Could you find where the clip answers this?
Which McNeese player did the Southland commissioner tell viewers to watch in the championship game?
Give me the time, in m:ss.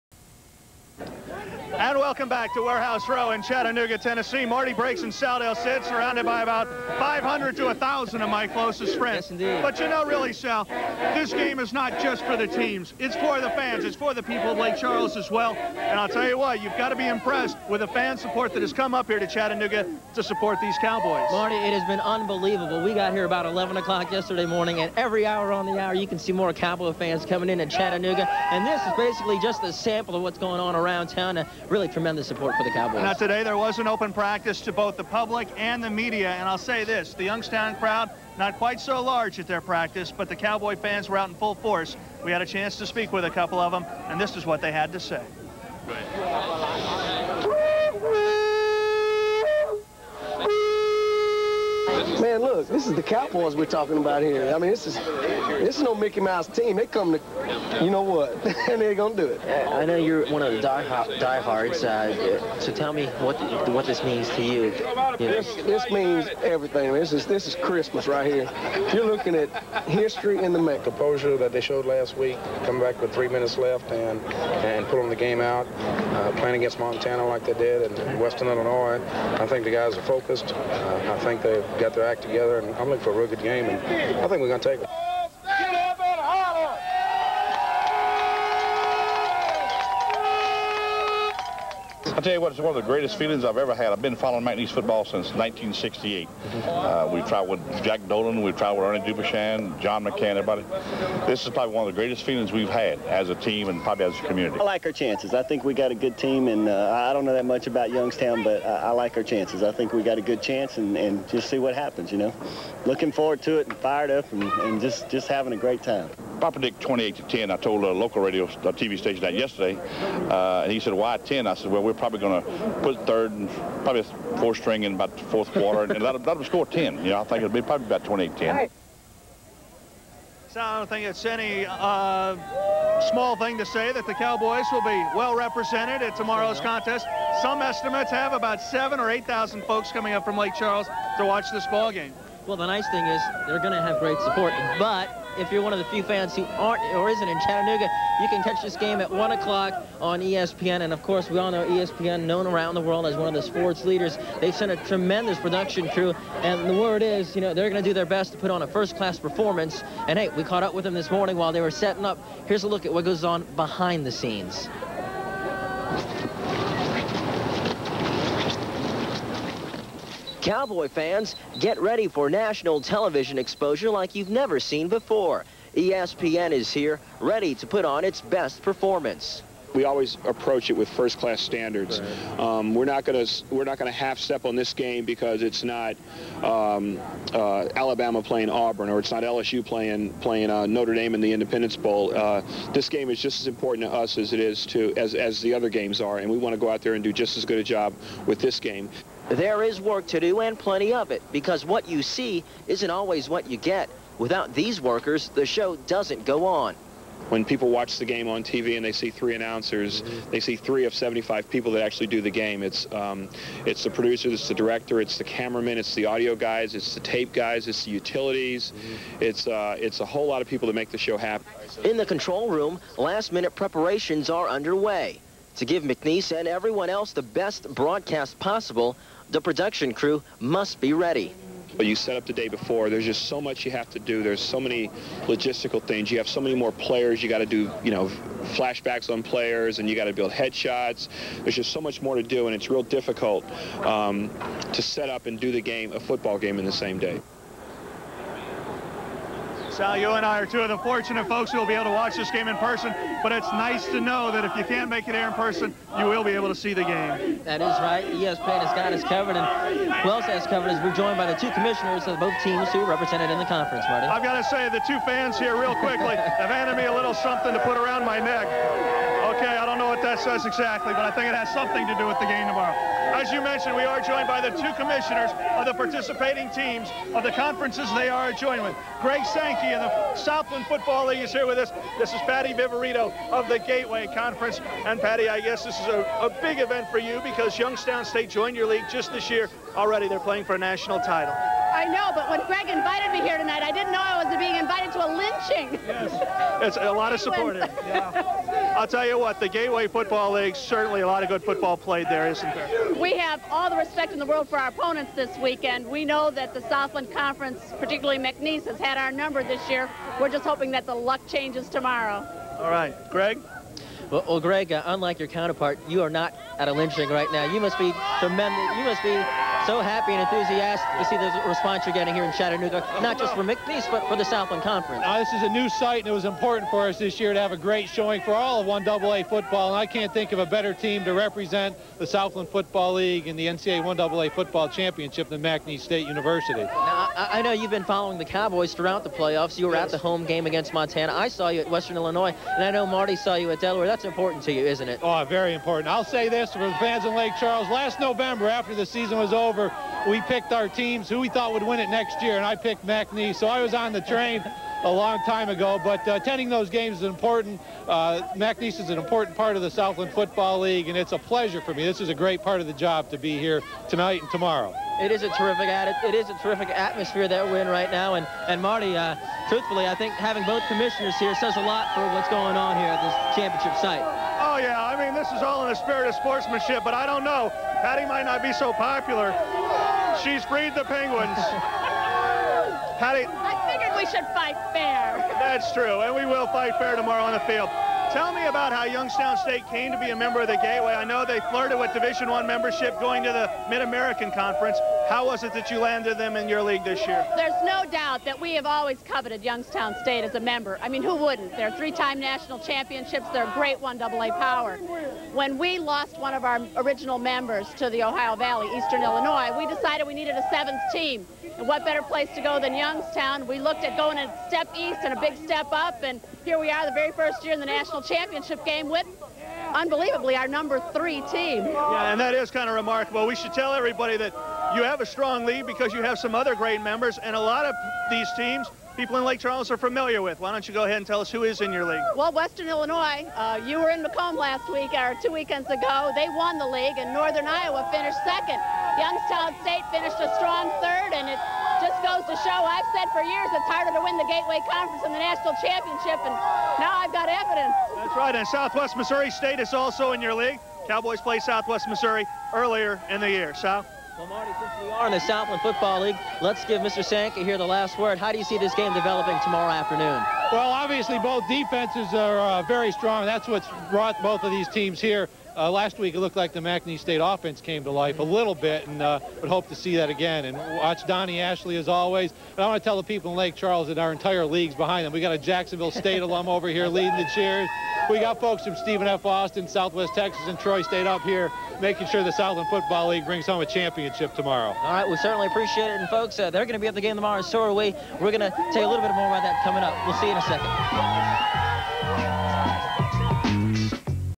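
7:51.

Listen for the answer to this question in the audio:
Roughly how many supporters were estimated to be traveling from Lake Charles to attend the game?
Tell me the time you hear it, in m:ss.
2:18.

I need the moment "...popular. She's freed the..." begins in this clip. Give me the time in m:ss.
6:18.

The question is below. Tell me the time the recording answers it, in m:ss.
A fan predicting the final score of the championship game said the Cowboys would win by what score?
1:56.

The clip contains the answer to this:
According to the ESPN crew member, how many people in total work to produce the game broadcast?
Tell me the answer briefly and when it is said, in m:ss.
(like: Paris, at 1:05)
75, at 3:30.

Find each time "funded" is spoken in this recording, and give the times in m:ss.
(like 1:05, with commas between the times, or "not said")
not said.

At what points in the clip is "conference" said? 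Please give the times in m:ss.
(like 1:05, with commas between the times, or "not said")
4:23, 4:37, 4:44, 5:07, 5:24, 6:34, 7:24.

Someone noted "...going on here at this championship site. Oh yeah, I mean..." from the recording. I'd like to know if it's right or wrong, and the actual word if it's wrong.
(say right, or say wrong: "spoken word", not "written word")
right.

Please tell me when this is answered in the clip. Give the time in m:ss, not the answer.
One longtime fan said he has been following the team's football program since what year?
1:35.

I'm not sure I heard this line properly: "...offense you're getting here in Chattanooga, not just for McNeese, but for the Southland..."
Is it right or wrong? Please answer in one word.
wrong.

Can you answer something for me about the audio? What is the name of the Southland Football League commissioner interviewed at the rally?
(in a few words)
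Greg Sankey.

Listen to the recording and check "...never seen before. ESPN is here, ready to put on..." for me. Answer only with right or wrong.
right.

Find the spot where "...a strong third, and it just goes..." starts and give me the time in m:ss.
7:20.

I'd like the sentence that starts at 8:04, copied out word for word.
All right, we certainly appreciate it.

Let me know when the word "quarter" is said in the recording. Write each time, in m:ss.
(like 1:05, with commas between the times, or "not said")
2:05.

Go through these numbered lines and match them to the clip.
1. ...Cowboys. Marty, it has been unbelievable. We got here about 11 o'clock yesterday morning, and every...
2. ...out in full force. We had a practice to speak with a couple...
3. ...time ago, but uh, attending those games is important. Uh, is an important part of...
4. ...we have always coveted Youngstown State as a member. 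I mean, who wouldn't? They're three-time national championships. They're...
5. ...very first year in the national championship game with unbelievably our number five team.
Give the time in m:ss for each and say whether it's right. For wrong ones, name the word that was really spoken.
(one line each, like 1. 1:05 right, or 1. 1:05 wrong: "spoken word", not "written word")
1. 0:20 right
2. 0:41 wrong: "chance", not "practice"
3. 5:55 right
4. 6:38 right
5. 6:56 wrong: "three", not "five".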